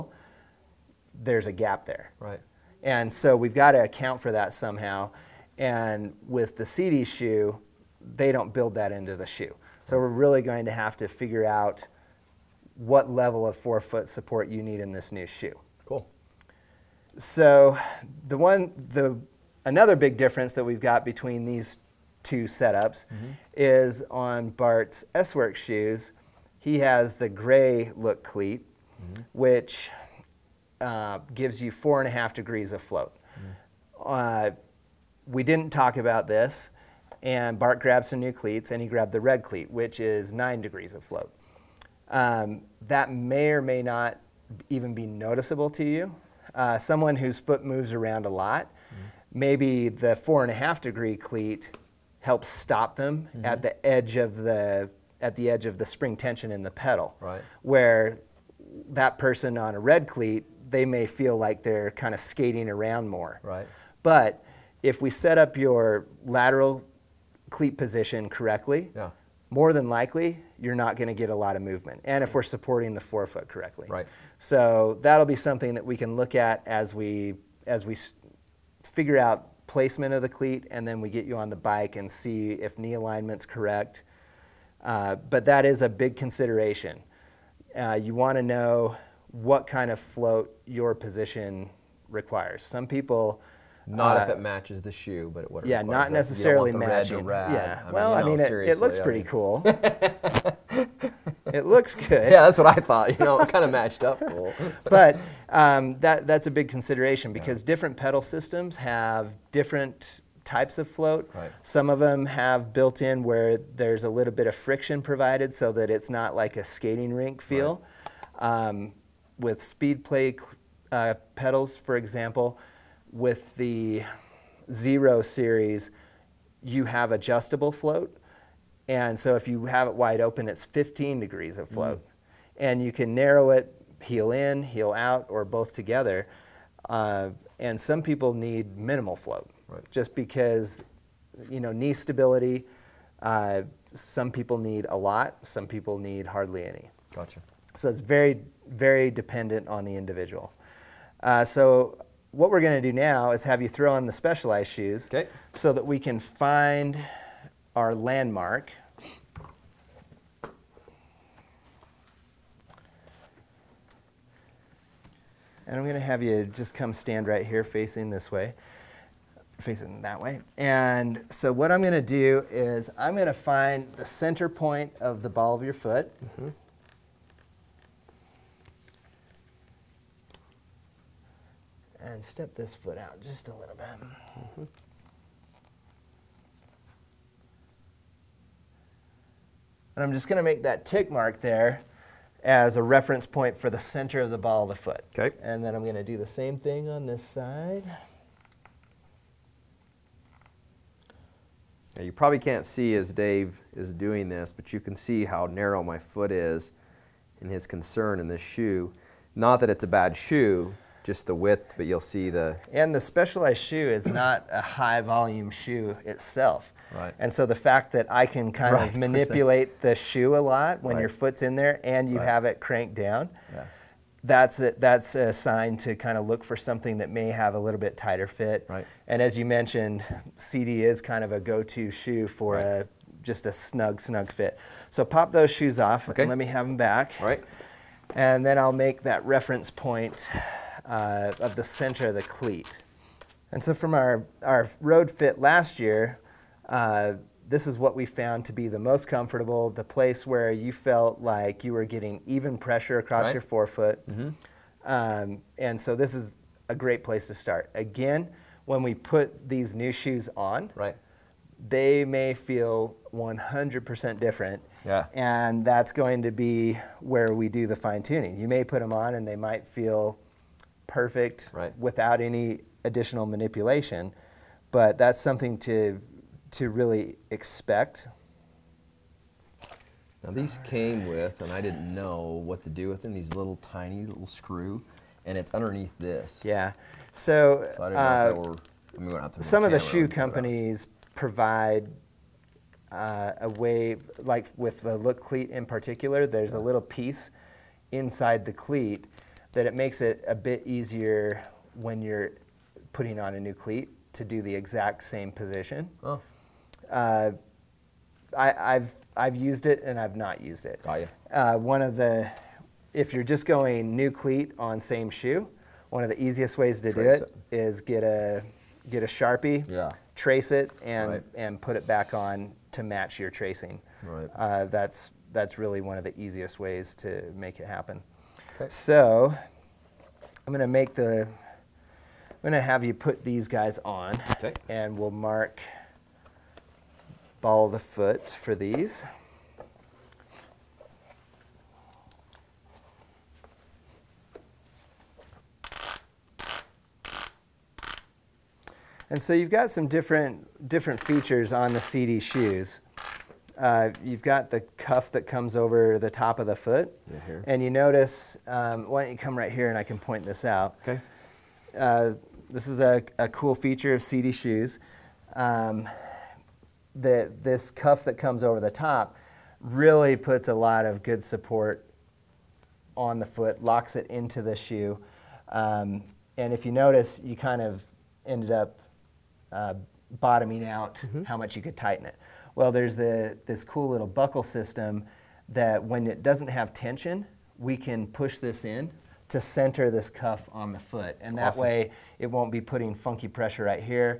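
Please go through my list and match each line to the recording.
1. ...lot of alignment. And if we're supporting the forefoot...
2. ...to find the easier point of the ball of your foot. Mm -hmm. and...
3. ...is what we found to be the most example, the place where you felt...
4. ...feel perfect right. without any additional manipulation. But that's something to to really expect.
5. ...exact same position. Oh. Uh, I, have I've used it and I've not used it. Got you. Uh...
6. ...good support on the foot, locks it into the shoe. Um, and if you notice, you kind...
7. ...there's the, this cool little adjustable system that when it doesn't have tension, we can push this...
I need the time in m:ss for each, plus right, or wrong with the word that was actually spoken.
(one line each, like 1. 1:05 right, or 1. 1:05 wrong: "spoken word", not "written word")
1. 1:11 wrong: "movement", not "alignment"
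2. 2:53 wrong: "center", not "easier"
3. 4:07 wrong: "comfortable", not "example"
4. 4:29 right
5. 5:04 right
6. 6:11 right
7. 6:22 wrong: "buckle", not "adjustable".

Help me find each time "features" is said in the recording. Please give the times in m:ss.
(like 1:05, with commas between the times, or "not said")
5:51, 6:03.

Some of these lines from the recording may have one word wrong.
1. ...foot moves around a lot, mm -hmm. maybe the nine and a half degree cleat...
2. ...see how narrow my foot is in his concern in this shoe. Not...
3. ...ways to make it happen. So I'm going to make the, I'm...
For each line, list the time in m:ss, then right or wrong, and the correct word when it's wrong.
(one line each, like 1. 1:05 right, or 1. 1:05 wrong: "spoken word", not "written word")
1. 0:47 wrong: "four", not "nine"
2. 3:24 right
3. 5:26 right.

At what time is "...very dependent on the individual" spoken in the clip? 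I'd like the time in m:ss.
2:28.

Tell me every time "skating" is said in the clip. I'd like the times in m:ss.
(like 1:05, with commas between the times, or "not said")
1:02, 1:56.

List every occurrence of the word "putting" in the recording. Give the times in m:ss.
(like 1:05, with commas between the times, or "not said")
5:02, 6:32.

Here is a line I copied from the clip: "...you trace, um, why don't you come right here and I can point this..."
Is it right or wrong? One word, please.
wrong.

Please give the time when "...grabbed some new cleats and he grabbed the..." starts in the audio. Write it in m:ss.
0:37.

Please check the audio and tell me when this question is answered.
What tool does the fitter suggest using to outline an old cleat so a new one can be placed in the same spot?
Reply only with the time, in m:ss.
5:19.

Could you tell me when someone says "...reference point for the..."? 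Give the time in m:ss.
3:12.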